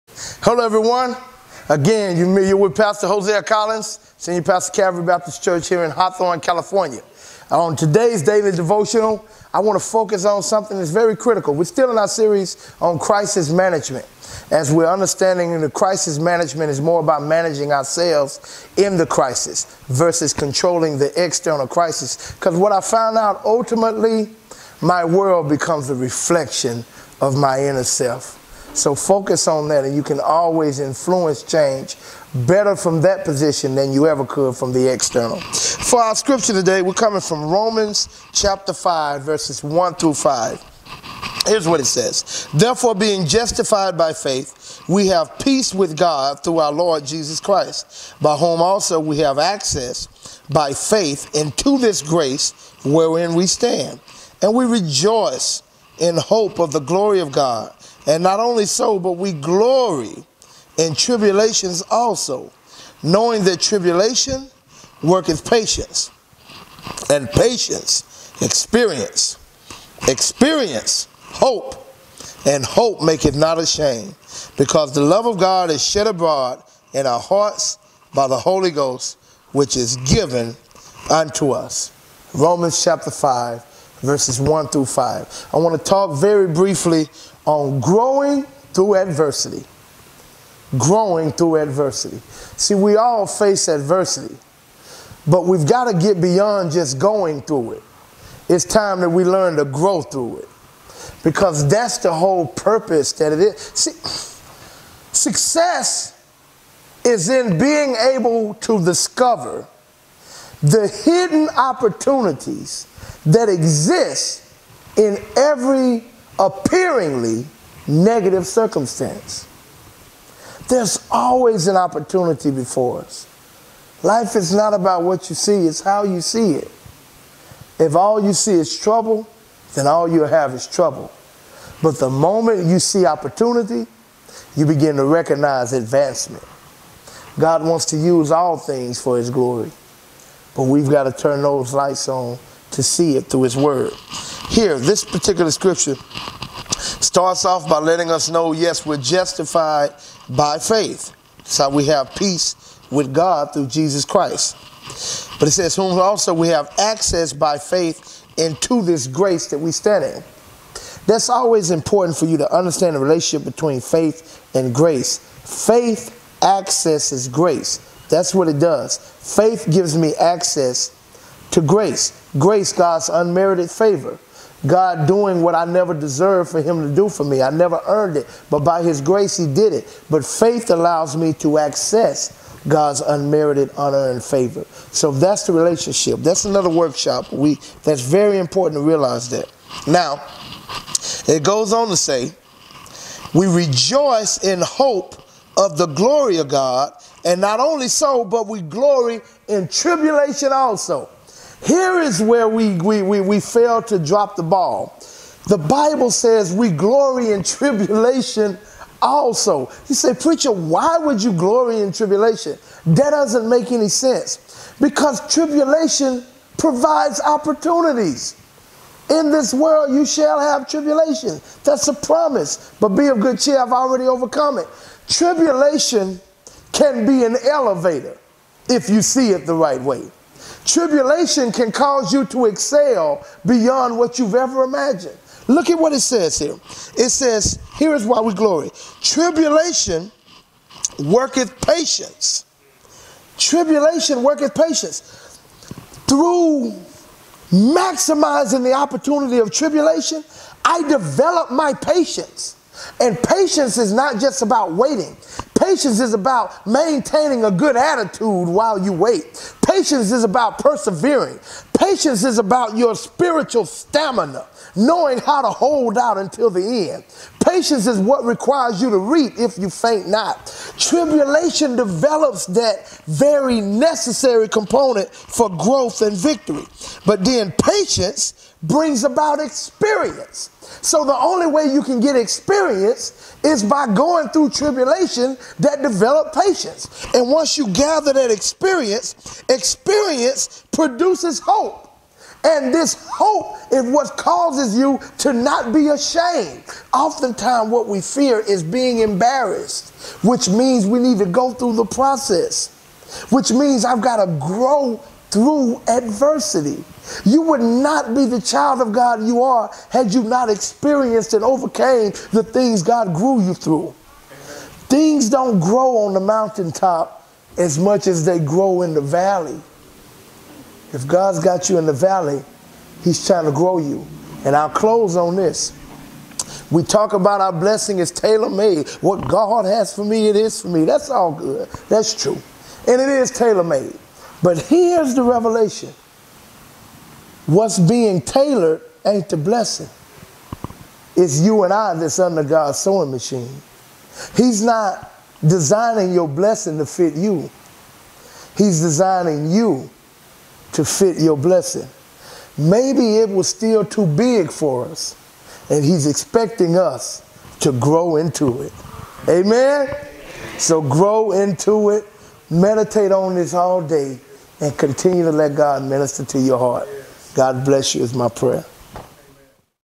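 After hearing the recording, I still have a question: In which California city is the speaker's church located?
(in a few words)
Hawthorne.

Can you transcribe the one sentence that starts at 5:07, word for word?
You would not be the child of God you are had you not experienced and overcame the things God grew you through.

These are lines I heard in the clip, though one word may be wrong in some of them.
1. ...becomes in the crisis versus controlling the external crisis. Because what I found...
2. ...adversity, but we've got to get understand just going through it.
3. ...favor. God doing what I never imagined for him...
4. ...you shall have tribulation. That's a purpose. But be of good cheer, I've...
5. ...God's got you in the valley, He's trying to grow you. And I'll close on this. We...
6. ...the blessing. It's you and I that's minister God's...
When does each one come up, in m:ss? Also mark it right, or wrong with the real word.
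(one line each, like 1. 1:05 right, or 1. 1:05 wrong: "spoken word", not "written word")
1. 0:17 wrong: "ourselves", not "becomes"
2. 1:33 wrong: "beyond", not "understand"
3. 2:53 wrong: "deserved", not "imagined"
4. 3:39 wrong: "promise", not "purpose"
5. 5:21 right
6. 5:39 wrong: "under", not "minister".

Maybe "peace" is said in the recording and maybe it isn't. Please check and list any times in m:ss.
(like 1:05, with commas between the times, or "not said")
0:45, 2:32.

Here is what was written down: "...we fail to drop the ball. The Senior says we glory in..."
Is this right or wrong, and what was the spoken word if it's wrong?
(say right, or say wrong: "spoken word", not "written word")
wrong: "Bible", not "Senior".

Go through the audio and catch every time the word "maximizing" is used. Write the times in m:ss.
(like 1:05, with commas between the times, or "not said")
4:07.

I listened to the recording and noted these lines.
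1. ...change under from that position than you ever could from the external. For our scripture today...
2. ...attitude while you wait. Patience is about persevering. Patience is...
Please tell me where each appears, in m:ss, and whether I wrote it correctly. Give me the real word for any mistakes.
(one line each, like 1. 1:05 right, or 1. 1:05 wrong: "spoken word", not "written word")
1. 0:31 wrong: "better", not "under"
2. 4:17 right.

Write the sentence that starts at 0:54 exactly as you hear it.
And we rejoice in hope of the glory of God.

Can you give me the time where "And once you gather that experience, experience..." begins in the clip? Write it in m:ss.
4:47.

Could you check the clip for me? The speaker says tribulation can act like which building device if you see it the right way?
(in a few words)
An elevator.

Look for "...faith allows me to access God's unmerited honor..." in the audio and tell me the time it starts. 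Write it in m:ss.
3:00.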